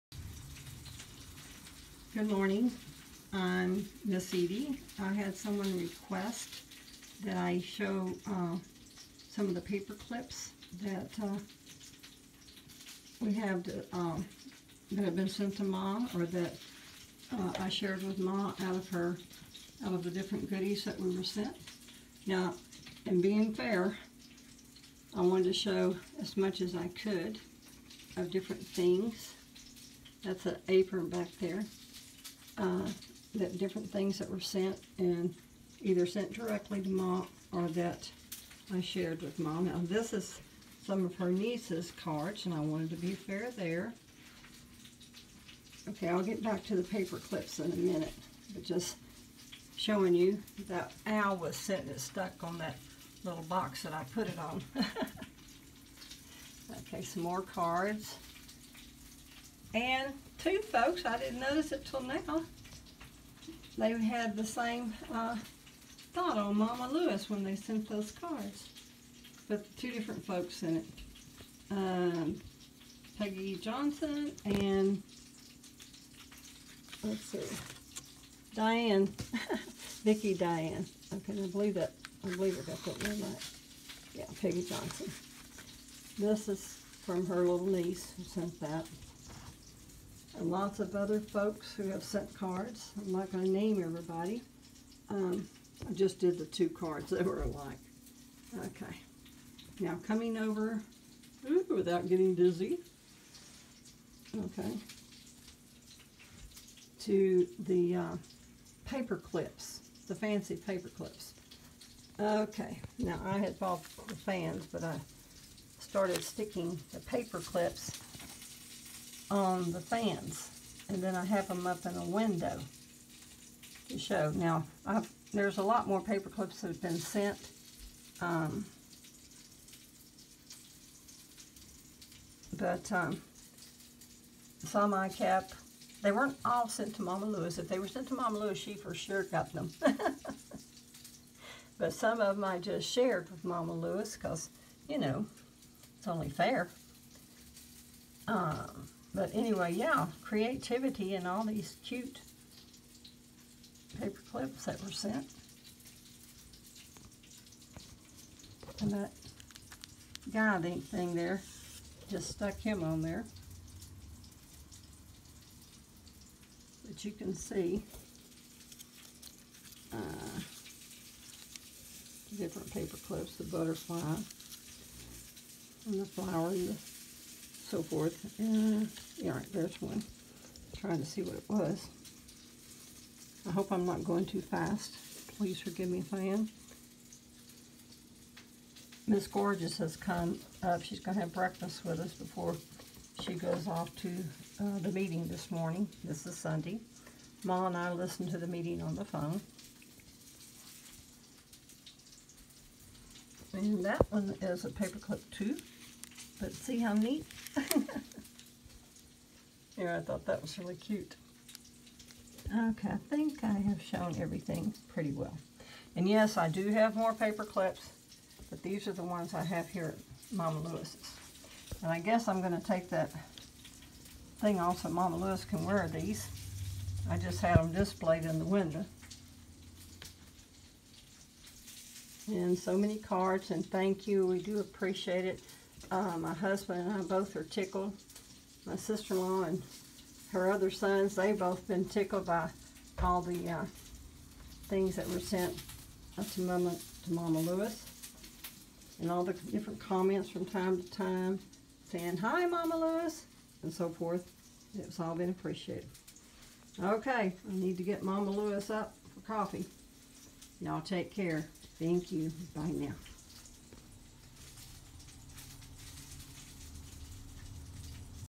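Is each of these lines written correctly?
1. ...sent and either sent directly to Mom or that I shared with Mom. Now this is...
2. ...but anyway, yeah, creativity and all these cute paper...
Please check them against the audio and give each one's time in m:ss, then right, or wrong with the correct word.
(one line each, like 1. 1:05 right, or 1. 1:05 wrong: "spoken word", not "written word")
1. 0:34 right
2. 2:29 right.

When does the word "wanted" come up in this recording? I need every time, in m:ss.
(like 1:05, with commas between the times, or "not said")
0:25, 0:42.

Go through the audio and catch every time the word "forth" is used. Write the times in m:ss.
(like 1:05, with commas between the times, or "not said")
2:57, 4:13.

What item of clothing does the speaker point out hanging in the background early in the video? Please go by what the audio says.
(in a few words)
apron.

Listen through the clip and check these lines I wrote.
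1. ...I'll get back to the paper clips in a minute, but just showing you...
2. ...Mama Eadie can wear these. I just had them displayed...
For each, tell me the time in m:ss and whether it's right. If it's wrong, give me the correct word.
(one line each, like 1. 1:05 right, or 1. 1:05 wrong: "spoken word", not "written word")
1. 0:46 right
2. 3:44 wrong: "Lewis", not "Eadie".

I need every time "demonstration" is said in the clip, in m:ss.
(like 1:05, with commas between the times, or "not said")
not said.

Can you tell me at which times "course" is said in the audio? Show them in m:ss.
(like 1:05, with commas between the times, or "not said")
not said.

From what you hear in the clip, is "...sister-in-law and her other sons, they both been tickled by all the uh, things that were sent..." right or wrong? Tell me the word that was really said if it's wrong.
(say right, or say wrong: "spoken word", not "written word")
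right.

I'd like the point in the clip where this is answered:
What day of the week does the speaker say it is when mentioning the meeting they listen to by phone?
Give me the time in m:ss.
3:16.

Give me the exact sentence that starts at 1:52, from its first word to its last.
Okay, now I had bought the fans, but I started sticking the paper clips on the fans.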